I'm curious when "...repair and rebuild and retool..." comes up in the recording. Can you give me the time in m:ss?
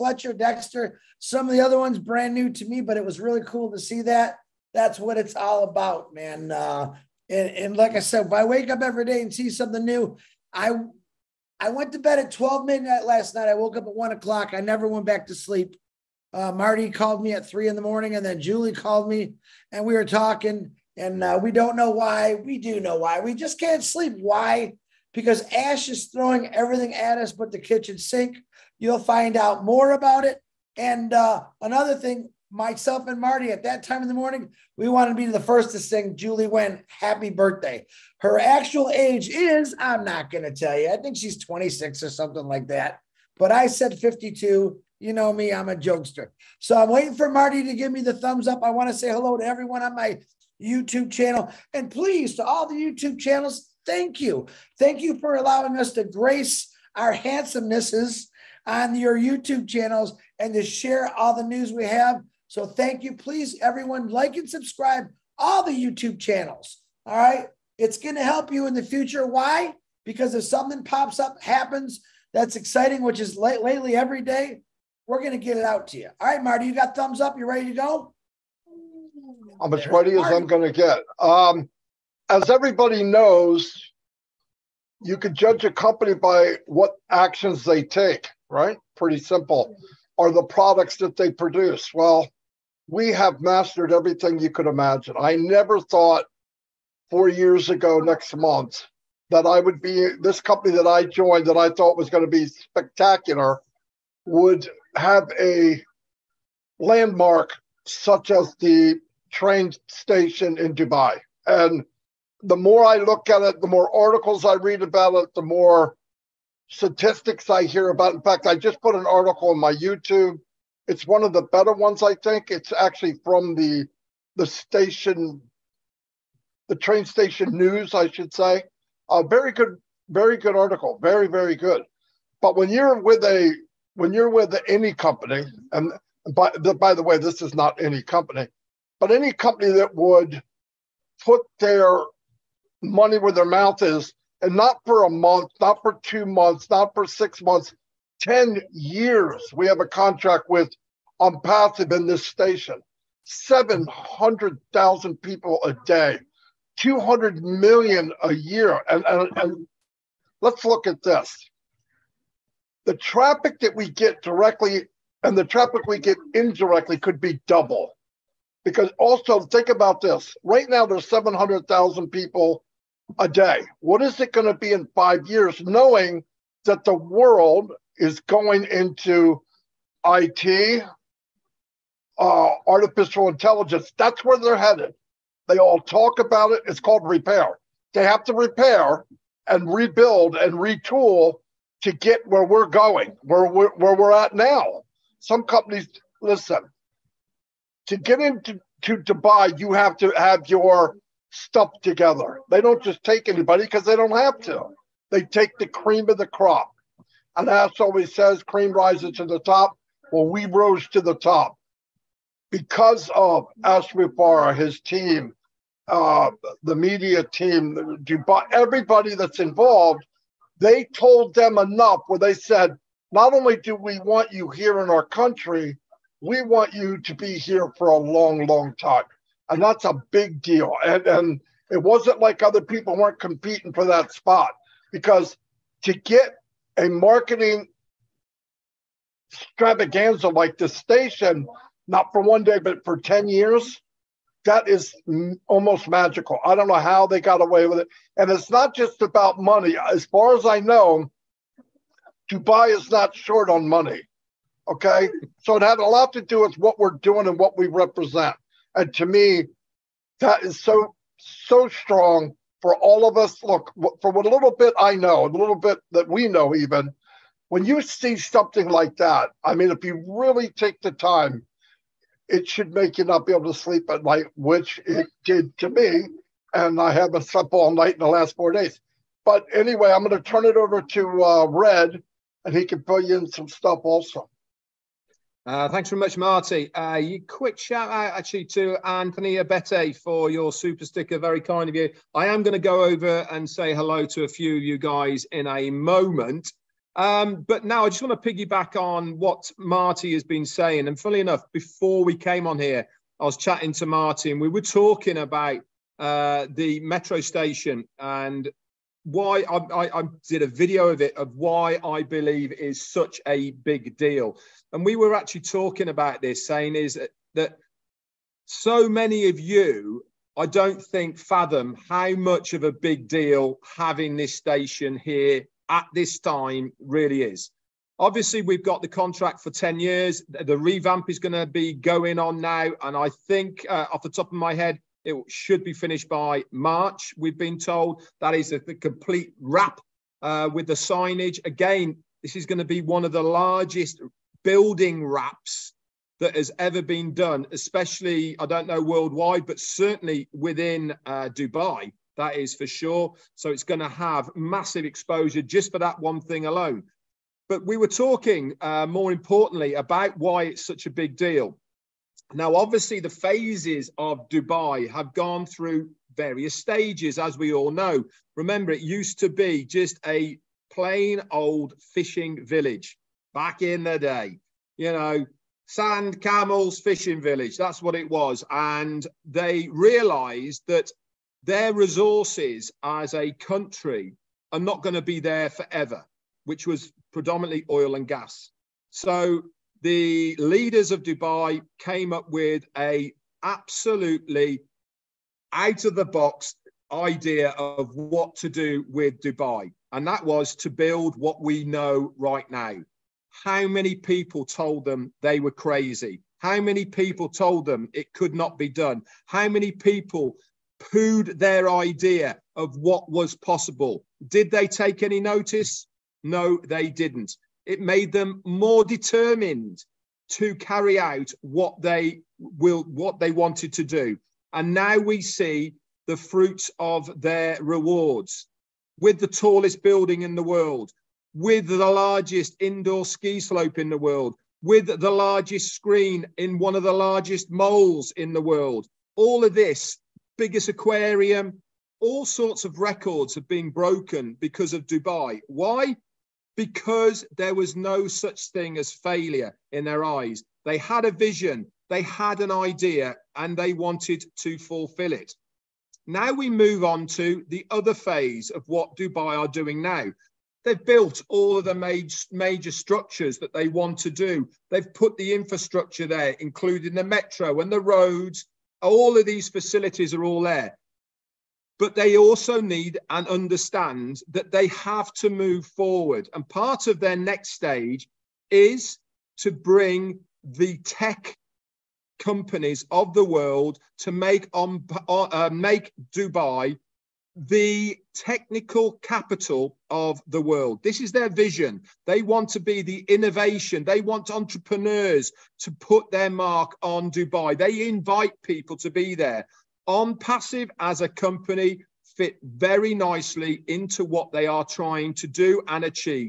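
3:08.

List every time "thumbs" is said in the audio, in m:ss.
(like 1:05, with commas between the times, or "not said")
0:48, 1:16.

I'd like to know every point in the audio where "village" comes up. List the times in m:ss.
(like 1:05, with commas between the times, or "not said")
6:12, 6:17.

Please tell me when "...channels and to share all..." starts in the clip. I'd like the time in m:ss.
0:59.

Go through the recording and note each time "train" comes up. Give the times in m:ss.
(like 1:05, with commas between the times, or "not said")
1:49, 2:06.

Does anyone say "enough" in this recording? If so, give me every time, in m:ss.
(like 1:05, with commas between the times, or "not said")
3:41, 5:01.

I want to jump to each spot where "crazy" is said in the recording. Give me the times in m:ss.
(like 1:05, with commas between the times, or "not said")
6:45.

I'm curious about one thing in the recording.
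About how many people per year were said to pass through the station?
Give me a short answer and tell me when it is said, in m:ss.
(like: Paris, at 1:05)
200 million, at 2:36.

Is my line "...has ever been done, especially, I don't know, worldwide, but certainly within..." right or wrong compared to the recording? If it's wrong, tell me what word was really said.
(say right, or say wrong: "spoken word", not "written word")
right.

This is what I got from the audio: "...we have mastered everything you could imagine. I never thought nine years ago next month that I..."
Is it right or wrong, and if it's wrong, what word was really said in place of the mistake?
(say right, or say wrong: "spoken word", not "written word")
wrong: "four", not "nine".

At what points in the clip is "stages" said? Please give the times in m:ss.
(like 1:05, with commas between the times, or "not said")
6:06, 7:57.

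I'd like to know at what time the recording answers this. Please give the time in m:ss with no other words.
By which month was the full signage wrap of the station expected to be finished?
5:36.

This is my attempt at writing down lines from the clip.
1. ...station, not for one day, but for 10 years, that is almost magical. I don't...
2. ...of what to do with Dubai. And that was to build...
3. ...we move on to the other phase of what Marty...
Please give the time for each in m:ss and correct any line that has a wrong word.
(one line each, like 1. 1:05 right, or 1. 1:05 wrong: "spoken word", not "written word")
1. 4:00 right
2. 6:37 right
3. 7:36 wrong: "Dubai", not "Marty".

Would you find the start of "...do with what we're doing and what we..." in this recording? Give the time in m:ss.
4:16.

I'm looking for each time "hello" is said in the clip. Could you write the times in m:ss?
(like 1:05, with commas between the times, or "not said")
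0:49, 4:53.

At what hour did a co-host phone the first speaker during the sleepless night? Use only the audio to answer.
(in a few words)
3 in the morning.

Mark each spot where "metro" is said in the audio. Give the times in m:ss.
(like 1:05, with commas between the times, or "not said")
5:06, 7:47.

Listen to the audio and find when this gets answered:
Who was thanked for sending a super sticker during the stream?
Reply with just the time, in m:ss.
4:48.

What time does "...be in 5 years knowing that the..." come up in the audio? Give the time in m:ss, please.
2:54.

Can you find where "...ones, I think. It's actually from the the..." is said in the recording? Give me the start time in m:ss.
2:01.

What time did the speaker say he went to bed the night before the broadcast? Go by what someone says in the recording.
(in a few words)
12 midnight.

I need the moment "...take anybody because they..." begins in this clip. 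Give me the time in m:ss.
3:23.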